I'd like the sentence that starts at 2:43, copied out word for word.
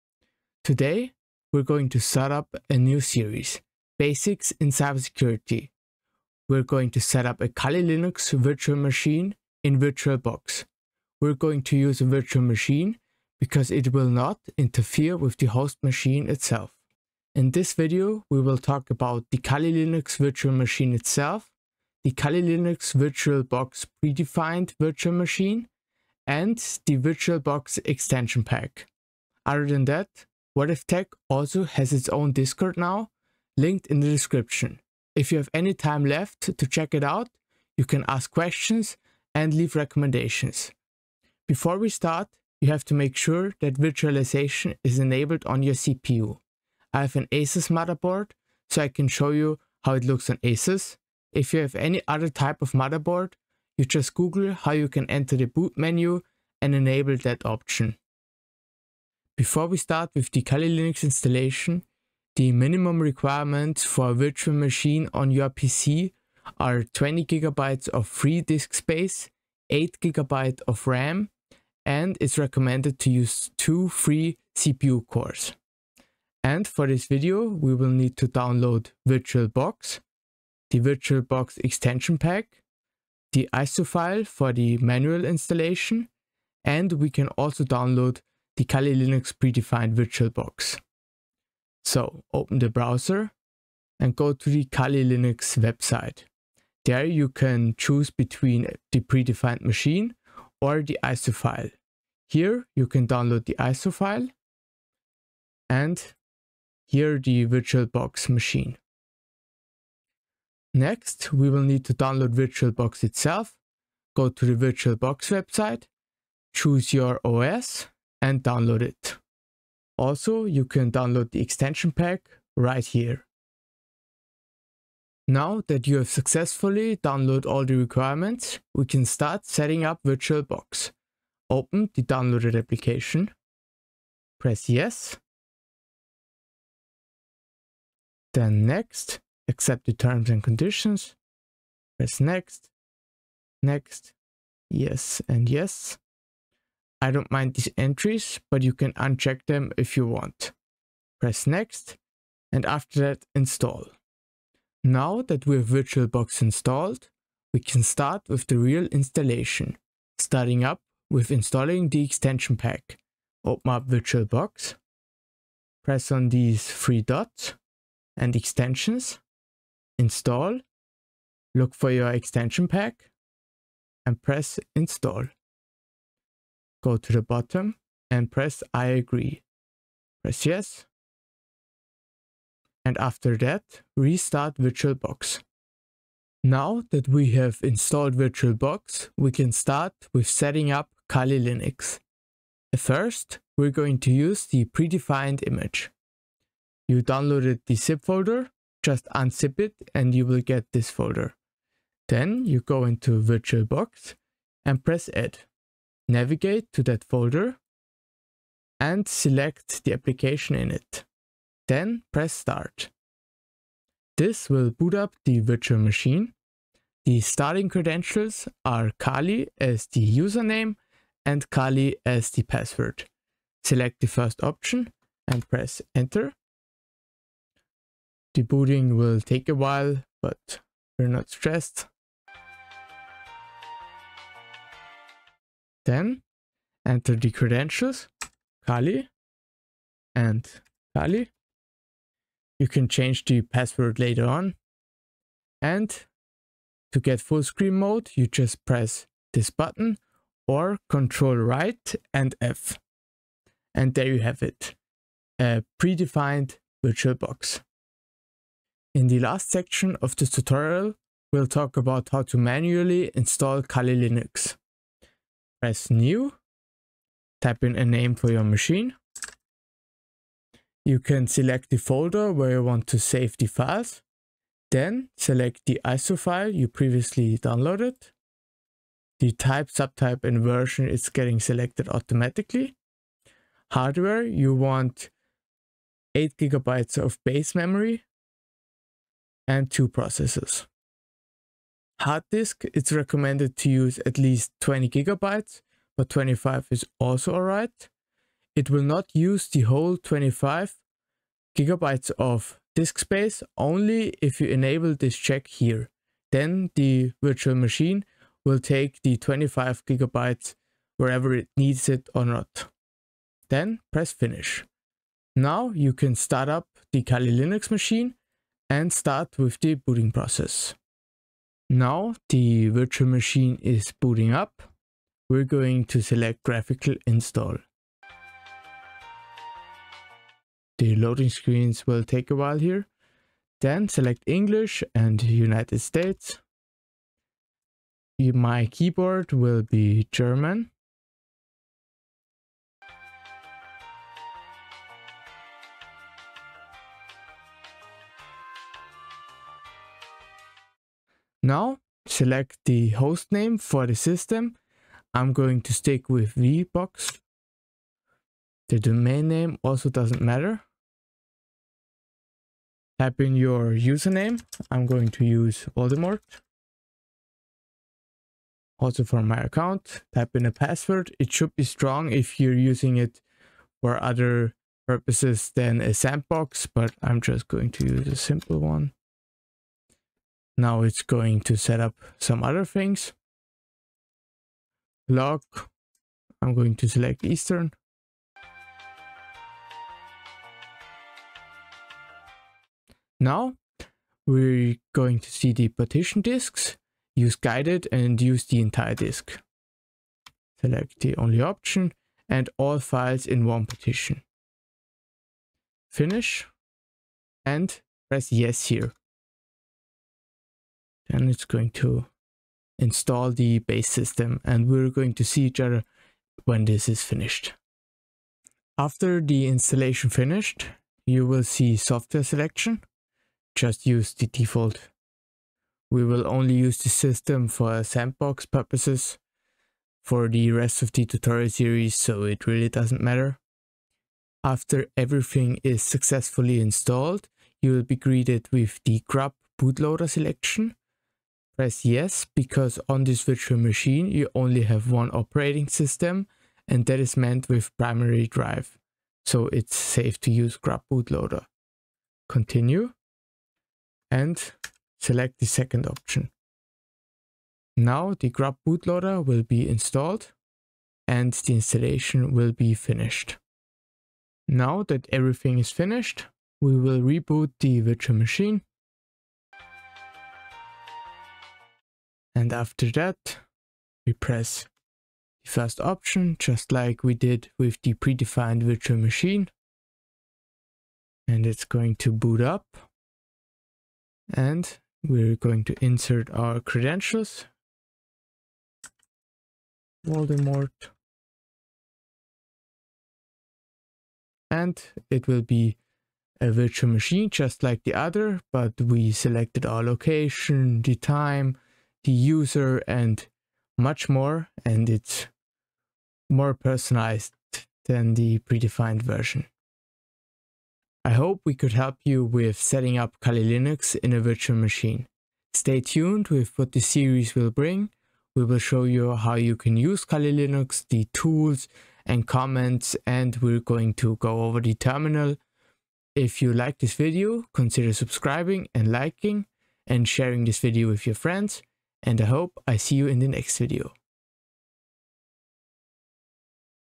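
Open up VirtualBox, press on these three dots and extensions, install, look for your extension pack and press install.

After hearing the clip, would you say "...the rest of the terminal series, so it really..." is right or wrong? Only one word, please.
wrong.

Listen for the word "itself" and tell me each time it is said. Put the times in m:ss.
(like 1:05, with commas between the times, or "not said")
0:16, 0:20, 1:53.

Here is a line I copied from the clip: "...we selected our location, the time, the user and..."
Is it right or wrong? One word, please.
right.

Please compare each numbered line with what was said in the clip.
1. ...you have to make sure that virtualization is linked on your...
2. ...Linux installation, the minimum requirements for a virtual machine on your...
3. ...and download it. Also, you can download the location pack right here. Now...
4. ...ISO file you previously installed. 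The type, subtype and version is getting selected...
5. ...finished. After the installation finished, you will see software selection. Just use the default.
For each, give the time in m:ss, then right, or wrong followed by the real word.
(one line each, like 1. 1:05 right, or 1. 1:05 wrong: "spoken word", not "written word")
1. 0:42 wrong: "enabled", not "linked"
2. 1:00 right
3. 1:58 wrong: "extension", not "location"
4. 4:35 wrong: "downloaded", not "installed"
5. 6:57 right.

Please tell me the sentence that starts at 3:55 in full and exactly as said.
Then enter the credentials, Kali and Kali.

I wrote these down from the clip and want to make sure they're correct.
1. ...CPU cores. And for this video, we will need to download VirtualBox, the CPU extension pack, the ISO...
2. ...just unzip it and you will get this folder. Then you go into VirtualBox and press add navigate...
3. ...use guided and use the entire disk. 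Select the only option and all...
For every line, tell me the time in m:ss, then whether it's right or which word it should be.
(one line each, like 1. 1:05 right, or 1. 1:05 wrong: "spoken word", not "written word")
1. 1:14 wrong: "VirtualBox", not "CPU"
2. 3:18 right
3. 6:37 right.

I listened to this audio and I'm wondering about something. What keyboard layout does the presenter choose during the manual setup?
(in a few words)
German.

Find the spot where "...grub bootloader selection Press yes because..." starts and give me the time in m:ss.
7:19.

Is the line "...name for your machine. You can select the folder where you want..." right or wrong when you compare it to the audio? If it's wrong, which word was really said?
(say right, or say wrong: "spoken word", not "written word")
right.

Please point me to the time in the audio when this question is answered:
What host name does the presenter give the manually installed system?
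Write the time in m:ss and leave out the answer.
5:56.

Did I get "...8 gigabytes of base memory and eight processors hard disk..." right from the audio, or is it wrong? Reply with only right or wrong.
wrong.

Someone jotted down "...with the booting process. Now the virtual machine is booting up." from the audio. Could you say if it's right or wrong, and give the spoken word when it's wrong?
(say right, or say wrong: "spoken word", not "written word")
right.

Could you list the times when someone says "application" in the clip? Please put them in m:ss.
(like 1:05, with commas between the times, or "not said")
2:12, 3:29.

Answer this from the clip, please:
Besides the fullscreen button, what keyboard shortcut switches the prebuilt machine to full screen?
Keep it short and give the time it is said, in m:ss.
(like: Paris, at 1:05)
Control right and F, at 4:10.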